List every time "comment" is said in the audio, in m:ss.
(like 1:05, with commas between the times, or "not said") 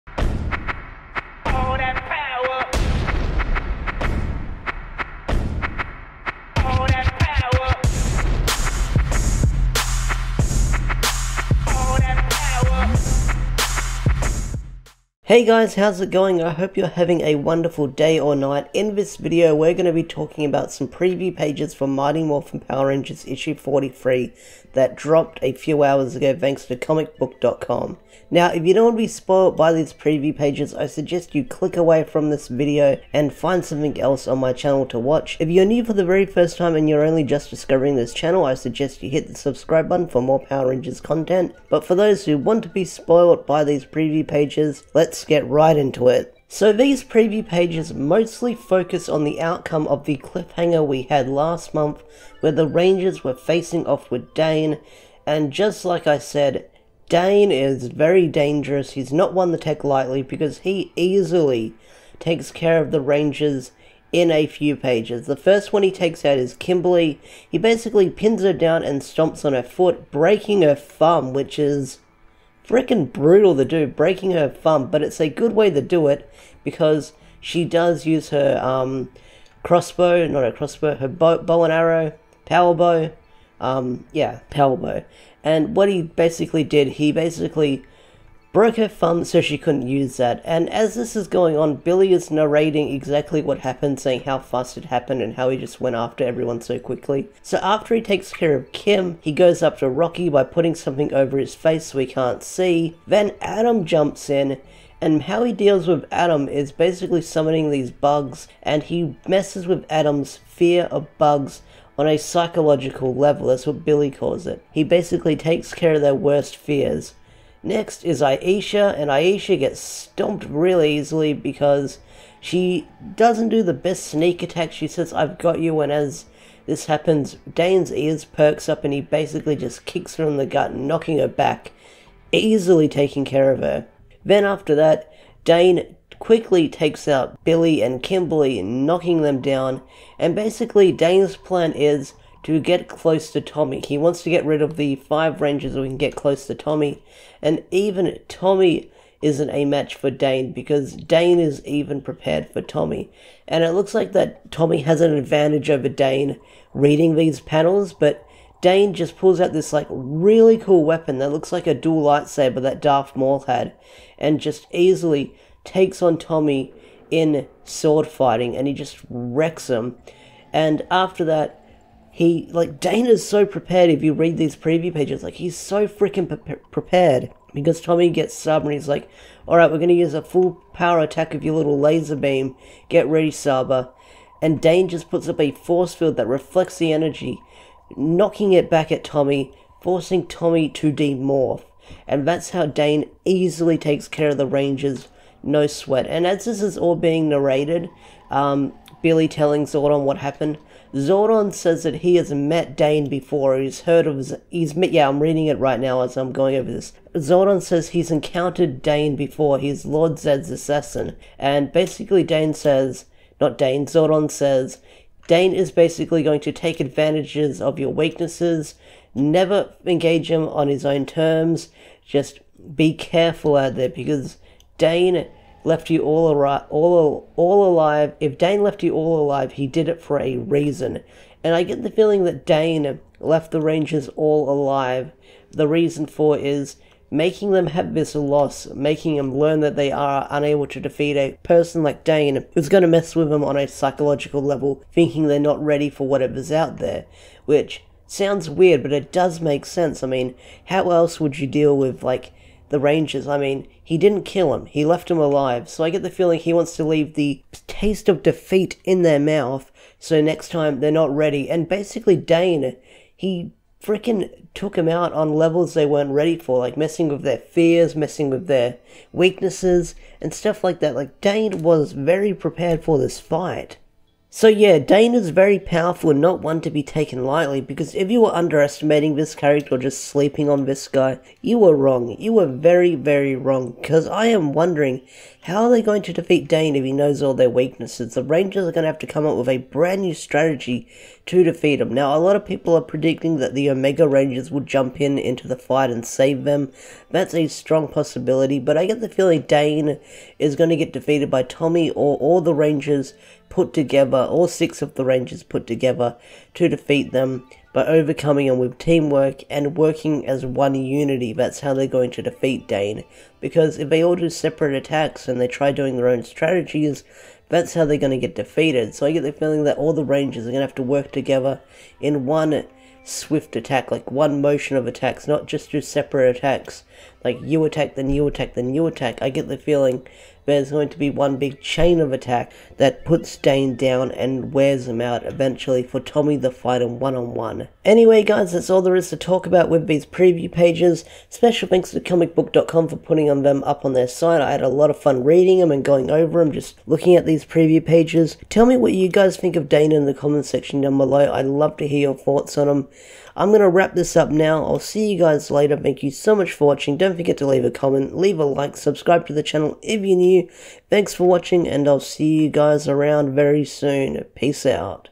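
5:50, 5:57.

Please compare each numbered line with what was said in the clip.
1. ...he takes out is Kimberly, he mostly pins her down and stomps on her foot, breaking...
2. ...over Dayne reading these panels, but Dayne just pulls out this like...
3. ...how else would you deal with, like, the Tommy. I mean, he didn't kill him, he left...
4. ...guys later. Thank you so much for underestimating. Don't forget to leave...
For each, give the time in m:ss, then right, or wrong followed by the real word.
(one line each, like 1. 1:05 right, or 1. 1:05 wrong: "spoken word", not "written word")
1. 1:05 wrong: "basically", not "mostly"
2. 2:35 right
3. 4:10 wrong: "Rangers", not "Tommy"
4. 5:55 wrong: "watching", not "underestimating".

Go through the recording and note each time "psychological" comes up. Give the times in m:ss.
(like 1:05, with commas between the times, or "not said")
1:52, 4:03.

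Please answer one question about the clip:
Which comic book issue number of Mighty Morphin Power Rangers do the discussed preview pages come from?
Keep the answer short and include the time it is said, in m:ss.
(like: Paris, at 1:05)
43, at 0:23.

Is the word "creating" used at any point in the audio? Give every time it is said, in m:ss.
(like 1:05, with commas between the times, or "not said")
not said.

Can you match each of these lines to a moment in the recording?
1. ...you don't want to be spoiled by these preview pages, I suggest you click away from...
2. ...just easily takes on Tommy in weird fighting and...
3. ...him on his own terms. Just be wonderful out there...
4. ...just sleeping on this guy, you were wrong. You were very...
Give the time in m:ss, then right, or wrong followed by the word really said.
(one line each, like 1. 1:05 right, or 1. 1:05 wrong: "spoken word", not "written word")
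1. 0:28 right
2. 2:44 wrong: "sword", not "weird"
3. 3:40 wrong: "careful", not "wonderful"
4. 4:39 right.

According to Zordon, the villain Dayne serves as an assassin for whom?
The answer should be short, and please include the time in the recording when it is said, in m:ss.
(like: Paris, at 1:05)
Lord Zedd, at 3:29.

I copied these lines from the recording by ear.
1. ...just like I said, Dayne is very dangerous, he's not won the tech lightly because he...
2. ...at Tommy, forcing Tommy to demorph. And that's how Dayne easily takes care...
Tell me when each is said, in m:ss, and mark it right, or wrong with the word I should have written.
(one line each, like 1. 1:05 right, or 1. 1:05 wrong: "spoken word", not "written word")
1. 0:55 right
2. 3:08 right.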